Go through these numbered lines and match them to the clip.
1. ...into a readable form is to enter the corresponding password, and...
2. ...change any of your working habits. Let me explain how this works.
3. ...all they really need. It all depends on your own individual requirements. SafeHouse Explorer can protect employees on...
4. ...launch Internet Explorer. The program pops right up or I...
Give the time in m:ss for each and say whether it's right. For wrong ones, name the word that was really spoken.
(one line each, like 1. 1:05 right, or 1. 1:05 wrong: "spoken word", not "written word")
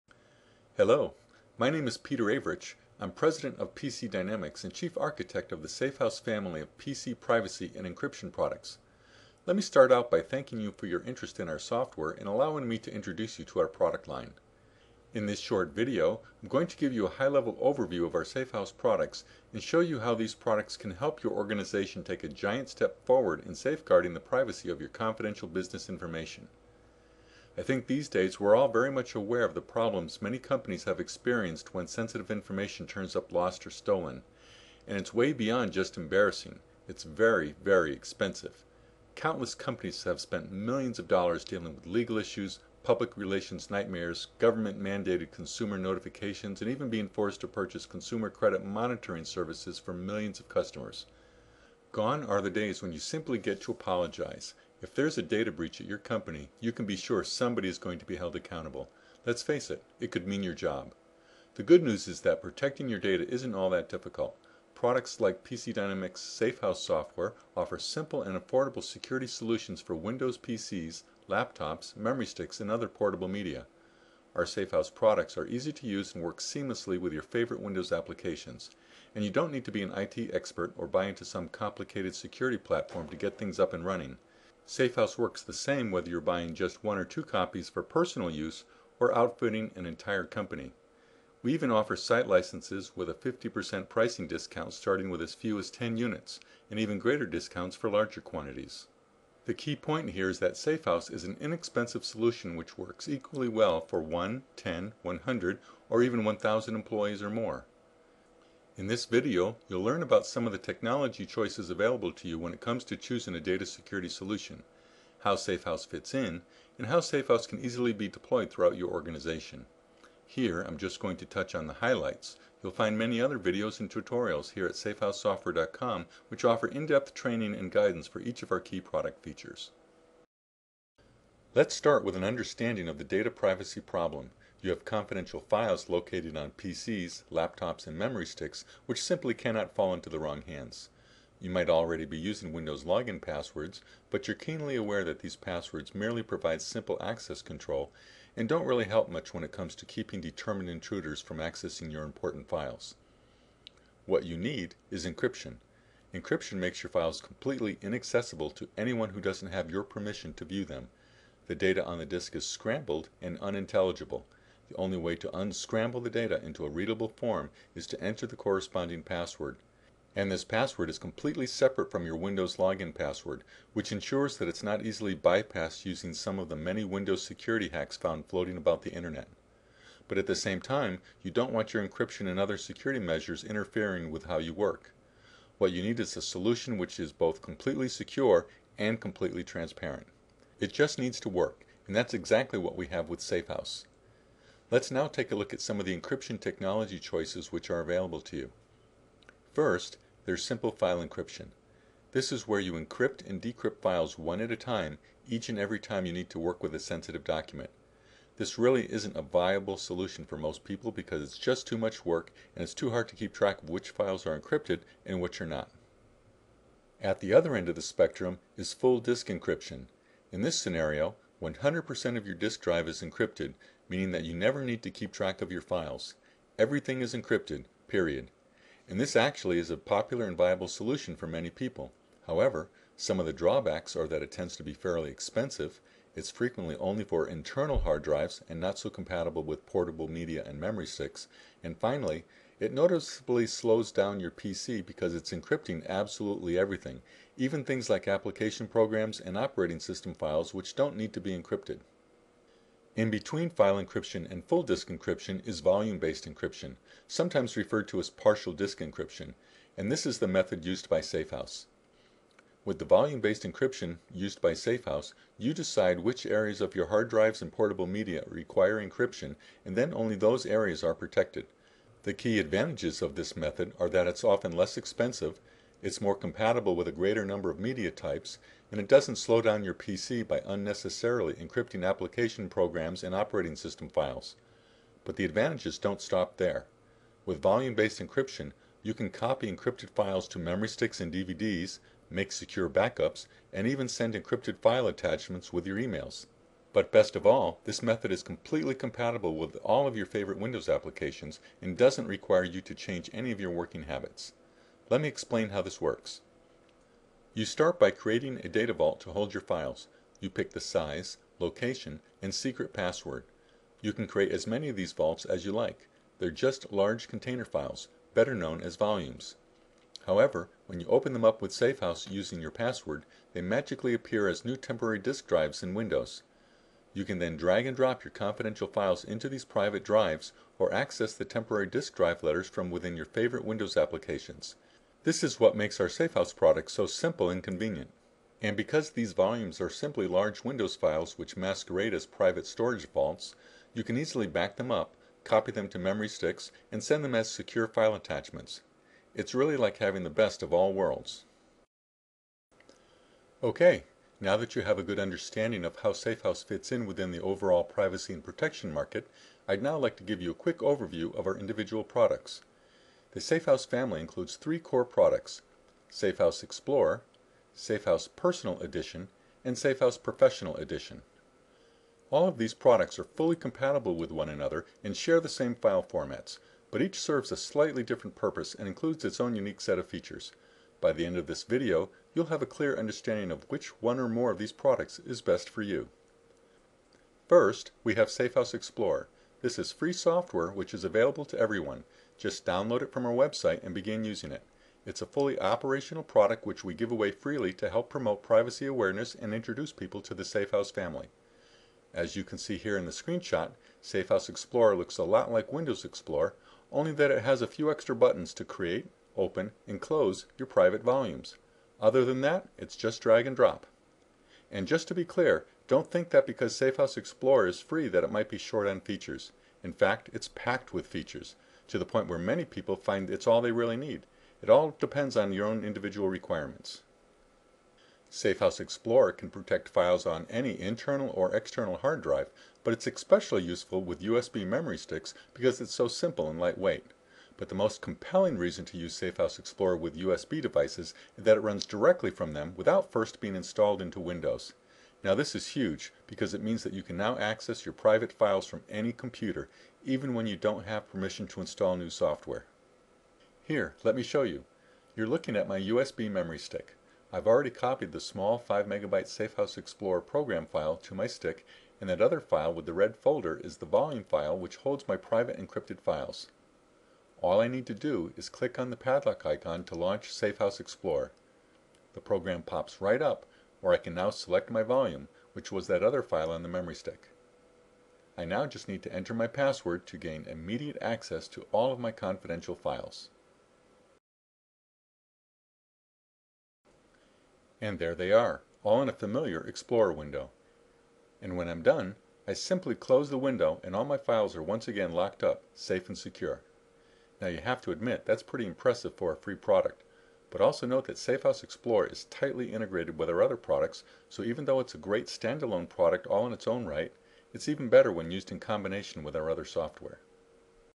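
1. 2:46 right
2. 5:02 right
3. 7:03 wrong: "files", not "employees"
4. 7:49 wrong: "SafeHouse", not "Internet".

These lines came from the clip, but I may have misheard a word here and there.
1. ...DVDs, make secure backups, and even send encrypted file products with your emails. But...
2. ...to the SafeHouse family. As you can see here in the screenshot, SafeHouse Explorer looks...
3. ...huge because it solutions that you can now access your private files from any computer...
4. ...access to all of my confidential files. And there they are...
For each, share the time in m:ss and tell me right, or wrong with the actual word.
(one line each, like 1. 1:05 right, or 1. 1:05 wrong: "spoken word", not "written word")
1. 4:51 wrong: "attachments", not "products"
2. 6:40 right
3. 7:25 wrong: "means", not "solutions"
4. 8:00 right.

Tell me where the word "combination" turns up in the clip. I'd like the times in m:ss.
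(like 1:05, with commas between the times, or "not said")
8:28.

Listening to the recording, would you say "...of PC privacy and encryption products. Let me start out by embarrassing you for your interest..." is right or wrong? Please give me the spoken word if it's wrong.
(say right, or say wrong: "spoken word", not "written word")
wrong: "thanking", not "embarrassing".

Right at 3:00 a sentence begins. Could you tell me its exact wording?
But at the same time, you don't want your encryption and other security measures interfering with how you work.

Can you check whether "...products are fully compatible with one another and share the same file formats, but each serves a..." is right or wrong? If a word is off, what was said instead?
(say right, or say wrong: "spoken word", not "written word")
right.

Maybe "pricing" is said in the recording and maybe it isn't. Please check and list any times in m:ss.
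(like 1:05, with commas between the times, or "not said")
1:33.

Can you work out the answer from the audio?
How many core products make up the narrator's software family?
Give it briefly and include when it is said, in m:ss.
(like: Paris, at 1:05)
3, at 6:04.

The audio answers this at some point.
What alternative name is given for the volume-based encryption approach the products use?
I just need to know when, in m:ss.
4:18.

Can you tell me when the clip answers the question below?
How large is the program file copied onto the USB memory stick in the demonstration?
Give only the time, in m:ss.
7:38.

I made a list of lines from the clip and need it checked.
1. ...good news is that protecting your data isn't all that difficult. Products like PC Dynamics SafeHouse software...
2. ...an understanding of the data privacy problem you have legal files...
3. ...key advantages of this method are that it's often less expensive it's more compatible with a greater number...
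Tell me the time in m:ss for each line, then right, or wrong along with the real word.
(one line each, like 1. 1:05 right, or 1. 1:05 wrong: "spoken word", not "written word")
1. 1:01 right
2. 2:12 wrong: "confidential", not "legal"
3. 4:32 right.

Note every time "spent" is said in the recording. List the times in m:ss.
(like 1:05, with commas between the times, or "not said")
0:40.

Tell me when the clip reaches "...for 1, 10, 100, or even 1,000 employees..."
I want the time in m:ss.
1:43.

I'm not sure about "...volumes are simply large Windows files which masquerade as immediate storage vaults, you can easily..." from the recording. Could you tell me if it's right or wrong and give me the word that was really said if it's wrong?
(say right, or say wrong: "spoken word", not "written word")
wrong: "private", not "immediate".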